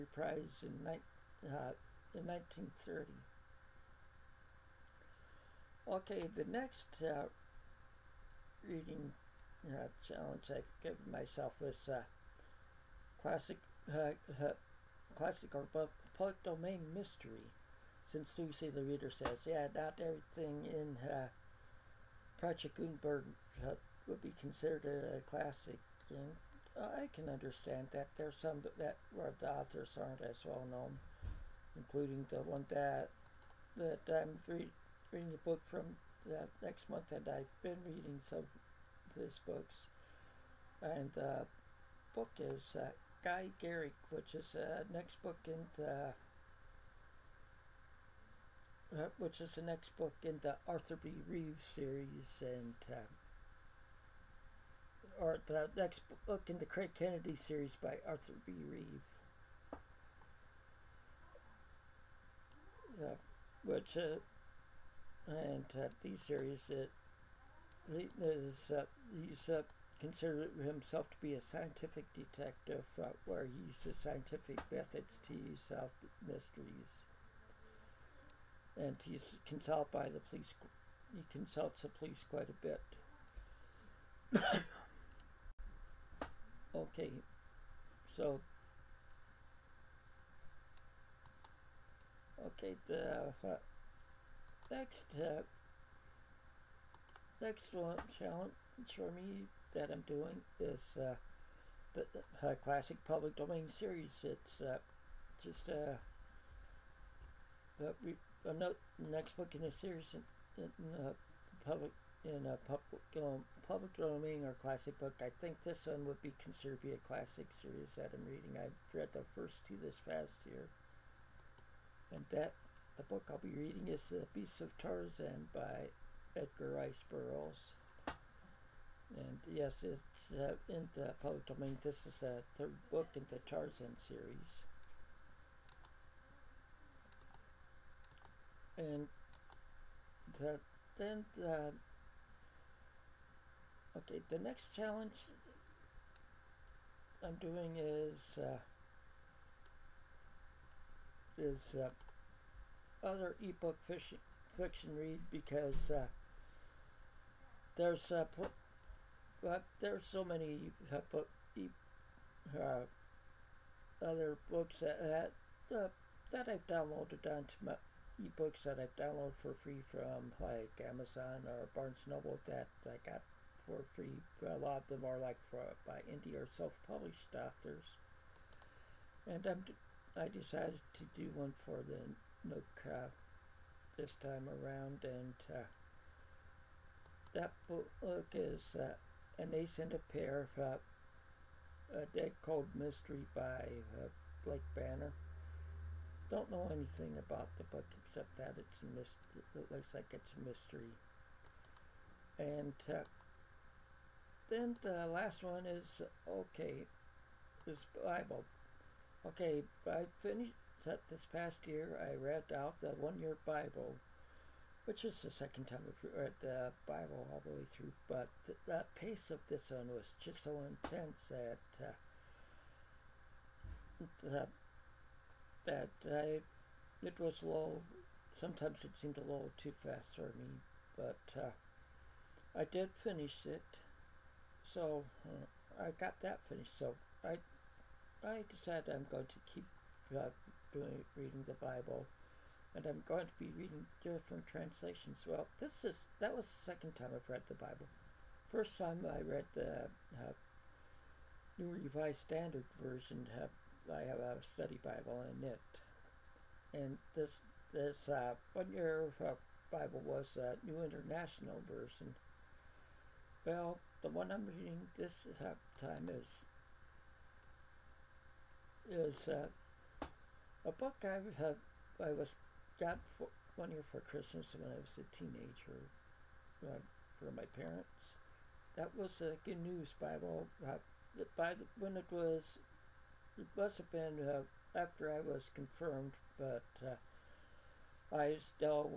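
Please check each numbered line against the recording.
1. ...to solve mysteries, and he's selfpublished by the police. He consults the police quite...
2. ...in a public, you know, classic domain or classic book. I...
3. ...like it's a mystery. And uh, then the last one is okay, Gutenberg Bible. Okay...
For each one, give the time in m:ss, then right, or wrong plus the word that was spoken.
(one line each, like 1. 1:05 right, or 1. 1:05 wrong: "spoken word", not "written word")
1. 1:15 wrong: "consulted", not "selfpublished"
2. 1:52 wrong: "public", not "classic"
3. 3:19 wrong: "This", not "Gutenberg".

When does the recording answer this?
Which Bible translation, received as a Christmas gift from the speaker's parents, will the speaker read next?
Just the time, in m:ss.
4:39.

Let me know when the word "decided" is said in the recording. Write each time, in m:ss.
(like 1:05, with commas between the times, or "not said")
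3:00, 3:58.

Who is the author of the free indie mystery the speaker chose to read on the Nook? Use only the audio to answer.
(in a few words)
Blake Banner.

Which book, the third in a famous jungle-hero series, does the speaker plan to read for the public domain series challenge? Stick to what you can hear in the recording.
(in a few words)
The Beast of Tarzan.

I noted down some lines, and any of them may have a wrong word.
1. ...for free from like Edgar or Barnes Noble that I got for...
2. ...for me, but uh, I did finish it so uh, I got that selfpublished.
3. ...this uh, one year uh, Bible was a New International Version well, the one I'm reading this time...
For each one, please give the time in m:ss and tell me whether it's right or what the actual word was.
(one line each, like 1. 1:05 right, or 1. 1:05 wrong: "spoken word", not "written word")
1. 2:49 wrong: "Amazon", not "Edgar"
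2. 3:50 wrong: "finished", not "selfpublished"
3. 4:17 right.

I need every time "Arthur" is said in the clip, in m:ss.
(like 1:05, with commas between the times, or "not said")
0:50, 0:58.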